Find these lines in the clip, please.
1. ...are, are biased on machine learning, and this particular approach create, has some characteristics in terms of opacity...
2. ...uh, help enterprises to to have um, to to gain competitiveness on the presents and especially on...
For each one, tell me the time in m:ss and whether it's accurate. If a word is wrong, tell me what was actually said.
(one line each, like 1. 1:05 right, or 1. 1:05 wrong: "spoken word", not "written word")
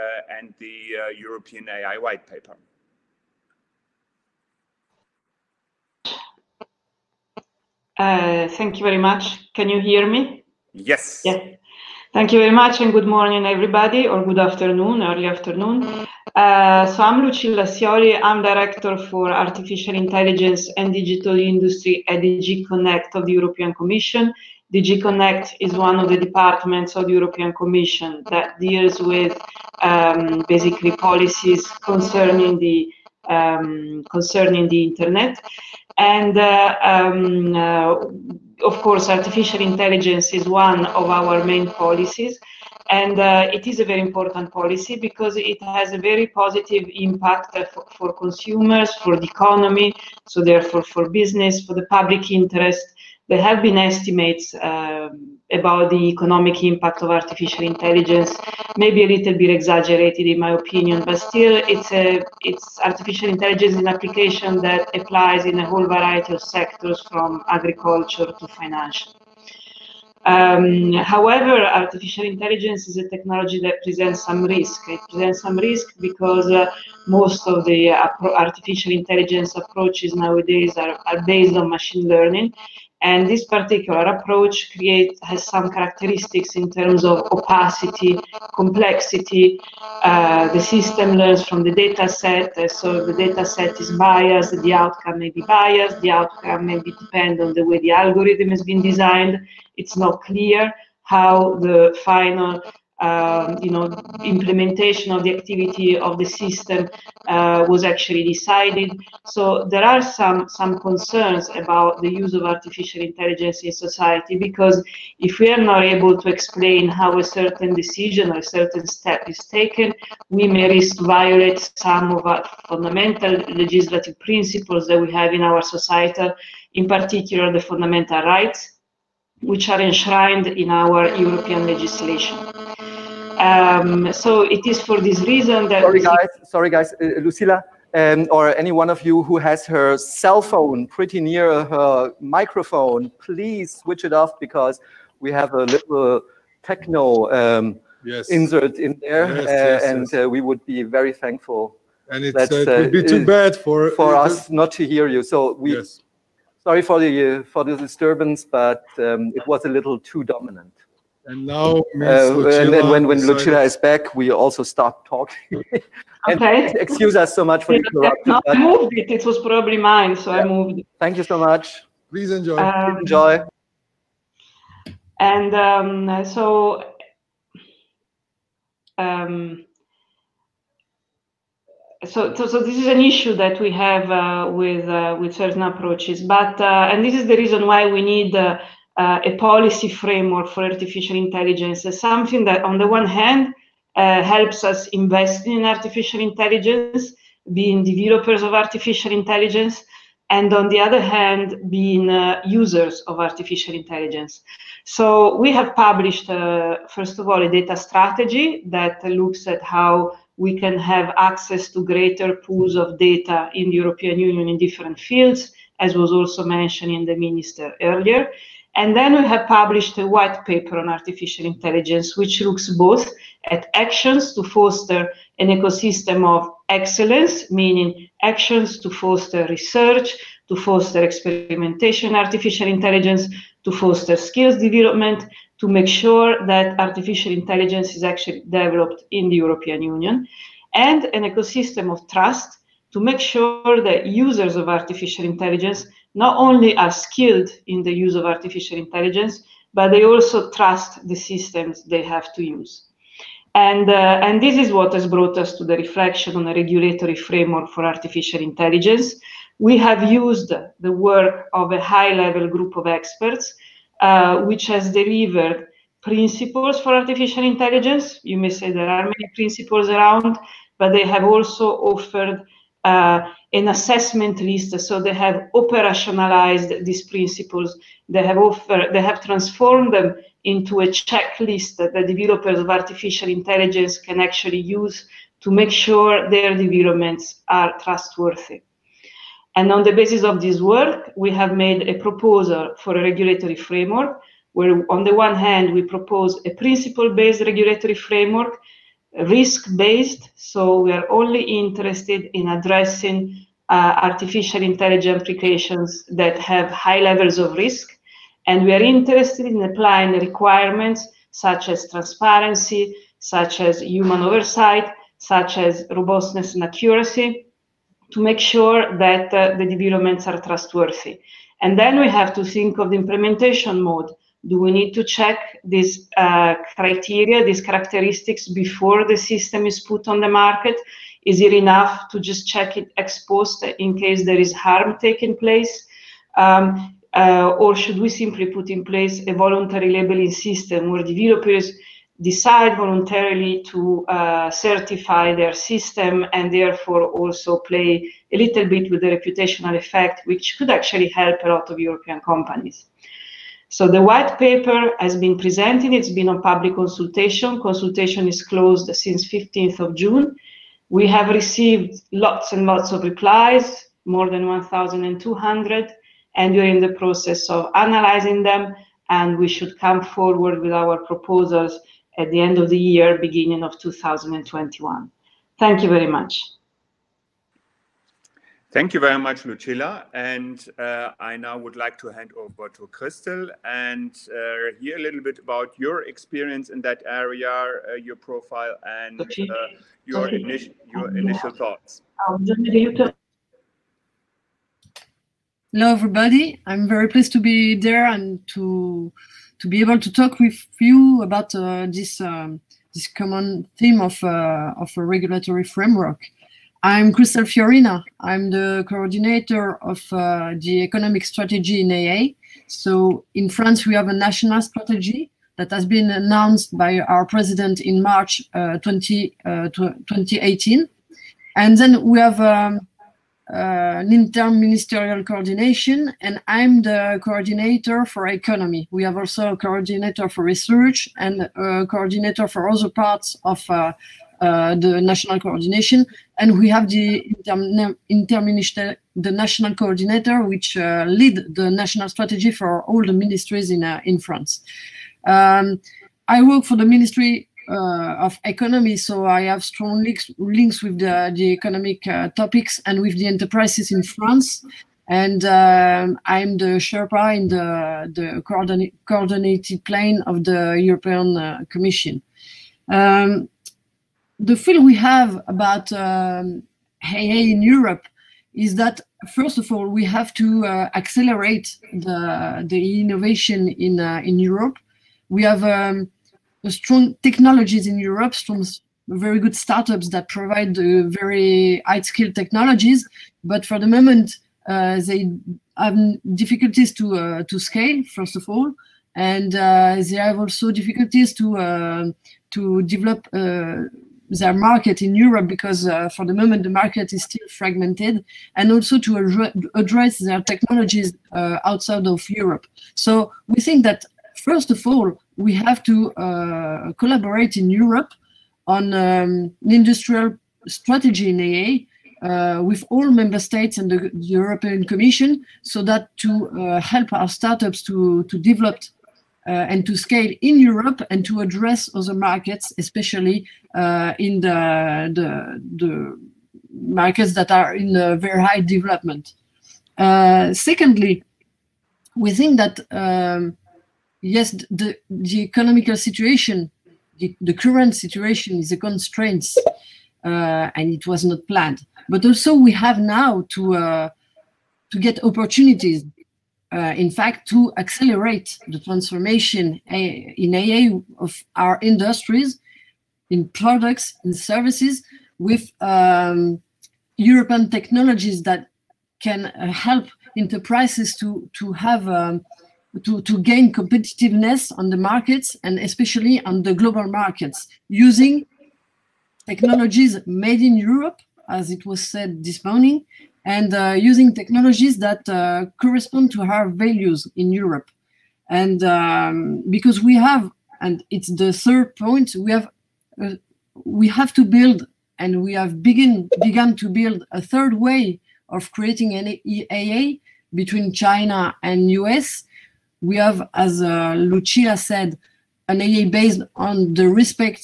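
1. 1:20 wrong: "based", not "biased"
2. 9:19 wrong: "markets", not "presents".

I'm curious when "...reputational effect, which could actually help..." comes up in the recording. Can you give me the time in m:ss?
5:49.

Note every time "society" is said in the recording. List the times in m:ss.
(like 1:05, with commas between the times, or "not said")
1:53, 2:05.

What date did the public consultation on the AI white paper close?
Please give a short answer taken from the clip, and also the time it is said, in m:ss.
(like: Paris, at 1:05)
15th of June, at 5:59.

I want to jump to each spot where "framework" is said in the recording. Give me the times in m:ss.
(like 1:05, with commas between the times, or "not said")
3:09, 4:17, 4:53, 4:57, 6:45.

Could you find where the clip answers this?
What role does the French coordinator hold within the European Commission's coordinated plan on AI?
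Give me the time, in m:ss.
7:36.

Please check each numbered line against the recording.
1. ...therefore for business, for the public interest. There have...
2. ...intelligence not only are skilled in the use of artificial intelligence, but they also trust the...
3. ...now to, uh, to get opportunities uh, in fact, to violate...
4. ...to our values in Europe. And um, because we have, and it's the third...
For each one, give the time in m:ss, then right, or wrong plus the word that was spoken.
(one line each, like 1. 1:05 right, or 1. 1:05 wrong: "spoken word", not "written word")
1. 0:50 right
2. 4:05 right
3. 9:02 wrong: "accelerate", not "violate"
4. 9:36 right.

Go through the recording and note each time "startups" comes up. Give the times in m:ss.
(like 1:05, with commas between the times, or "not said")
7:59, 8:37.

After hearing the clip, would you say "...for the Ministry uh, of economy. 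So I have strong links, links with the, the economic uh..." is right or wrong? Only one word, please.
right.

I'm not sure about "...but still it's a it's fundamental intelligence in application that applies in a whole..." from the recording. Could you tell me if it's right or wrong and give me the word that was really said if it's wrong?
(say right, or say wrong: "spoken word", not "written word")
wrong: "artificial", not "fundamental".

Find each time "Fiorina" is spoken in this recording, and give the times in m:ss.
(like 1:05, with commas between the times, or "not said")
6:47.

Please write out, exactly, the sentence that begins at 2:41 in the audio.
And now, uh, and then when, when Lucilla is back, we also stop talking.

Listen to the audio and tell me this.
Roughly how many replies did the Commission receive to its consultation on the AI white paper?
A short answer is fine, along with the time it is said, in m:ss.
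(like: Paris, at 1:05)
more than 1,200, at 6:04.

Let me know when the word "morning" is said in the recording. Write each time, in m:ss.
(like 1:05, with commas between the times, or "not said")
0:13, 9:32.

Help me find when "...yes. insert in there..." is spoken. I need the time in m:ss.
2:28.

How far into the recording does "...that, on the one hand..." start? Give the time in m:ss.
3:12.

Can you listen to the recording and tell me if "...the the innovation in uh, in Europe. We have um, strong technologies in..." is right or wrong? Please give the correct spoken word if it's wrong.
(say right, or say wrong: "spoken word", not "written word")
right.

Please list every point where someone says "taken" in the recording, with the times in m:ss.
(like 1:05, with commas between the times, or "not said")
1:59.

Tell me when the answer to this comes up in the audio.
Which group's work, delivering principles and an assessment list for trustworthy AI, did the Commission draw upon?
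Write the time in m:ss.
4:21.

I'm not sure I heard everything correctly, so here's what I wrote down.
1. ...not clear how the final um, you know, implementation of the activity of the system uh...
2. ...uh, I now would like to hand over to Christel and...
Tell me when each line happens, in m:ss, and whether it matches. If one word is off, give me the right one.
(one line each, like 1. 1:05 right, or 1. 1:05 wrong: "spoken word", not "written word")
1. 1:39 right
2. 6:20 right.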